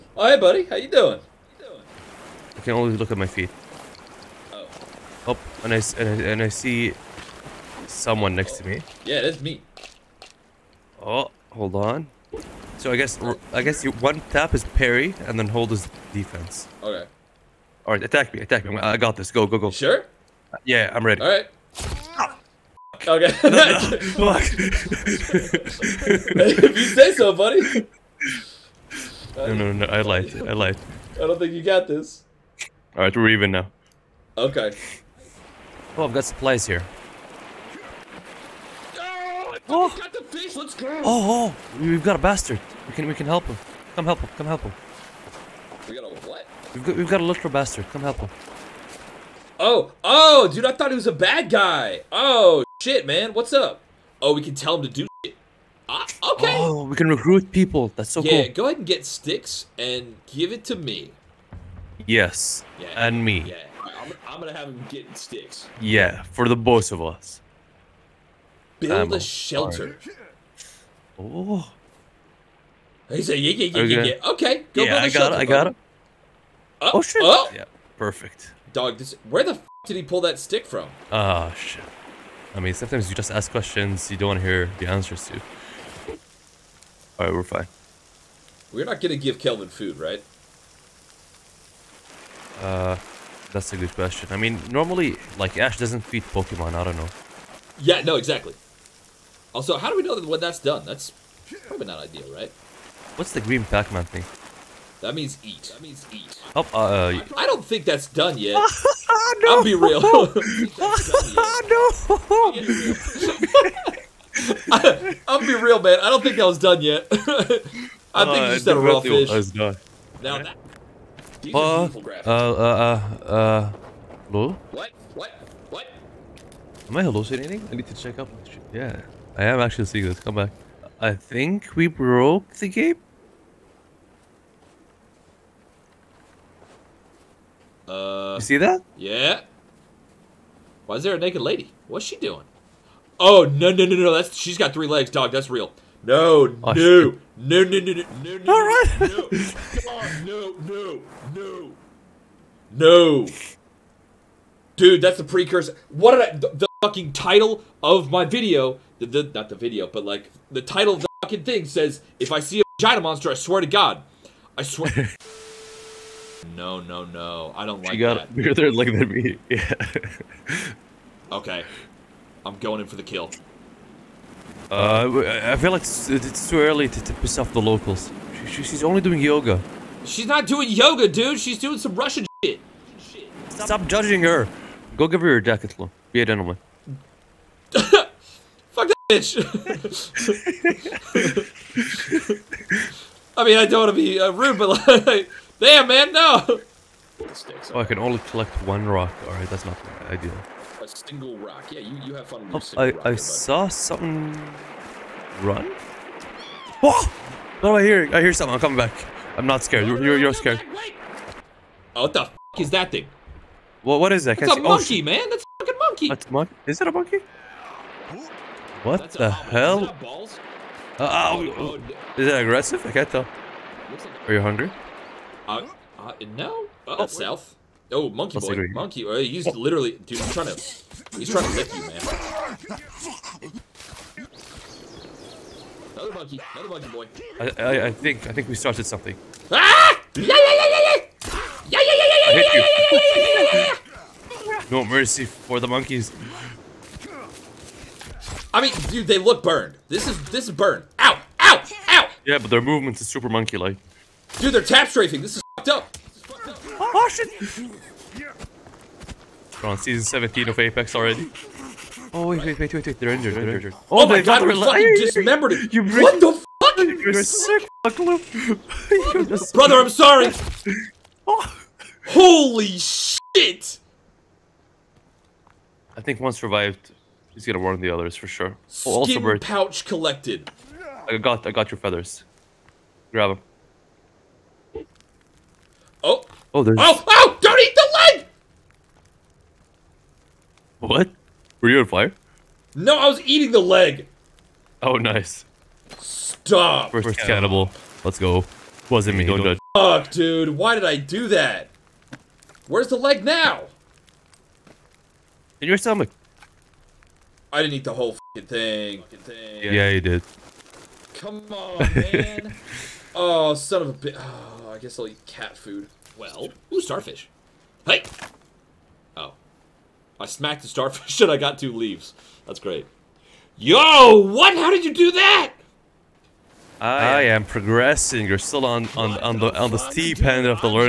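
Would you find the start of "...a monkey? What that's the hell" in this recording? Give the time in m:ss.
3:36.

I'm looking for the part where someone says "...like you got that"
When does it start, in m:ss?
2:47.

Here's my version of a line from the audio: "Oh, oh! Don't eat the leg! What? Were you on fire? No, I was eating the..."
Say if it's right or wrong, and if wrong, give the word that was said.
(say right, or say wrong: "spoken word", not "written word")
right.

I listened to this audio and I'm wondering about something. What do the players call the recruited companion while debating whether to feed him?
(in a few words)
Kelvin.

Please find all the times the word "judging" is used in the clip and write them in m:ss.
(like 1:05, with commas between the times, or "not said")
3:03.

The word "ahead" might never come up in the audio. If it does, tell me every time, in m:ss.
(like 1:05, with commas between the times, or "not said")
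0:58.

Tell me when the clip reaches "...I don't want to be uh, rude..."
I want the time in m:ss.
3:13.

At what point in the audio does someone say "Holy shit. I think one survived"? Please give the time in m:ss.
4:32.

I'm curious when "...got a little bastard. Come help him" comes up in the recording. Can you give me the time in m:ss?
0:47.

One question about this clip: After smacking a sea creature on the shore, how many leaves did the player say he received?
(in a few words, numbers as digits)
2.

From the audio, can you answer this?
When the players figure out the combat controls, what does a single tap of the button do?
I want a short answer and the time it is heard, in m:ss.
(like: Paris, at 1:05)
Parry, at 0:14.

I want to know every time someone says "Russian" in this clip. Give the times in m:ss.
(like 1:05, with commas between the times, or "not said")
3:01.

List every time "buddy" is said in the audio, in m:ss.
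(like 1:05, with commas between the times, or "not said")
0:00, 0:27.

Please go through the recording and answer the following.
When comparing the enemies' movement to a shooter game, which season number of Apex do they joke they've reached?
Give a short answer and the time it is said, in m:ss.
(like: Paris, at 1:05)
17, at 4:19.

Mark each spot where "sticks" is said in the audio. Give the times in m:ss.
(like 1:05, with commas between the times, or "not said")
0:59, 1:05, 1:20.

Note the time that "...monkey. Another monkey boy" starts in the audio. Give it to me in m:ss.
3:56.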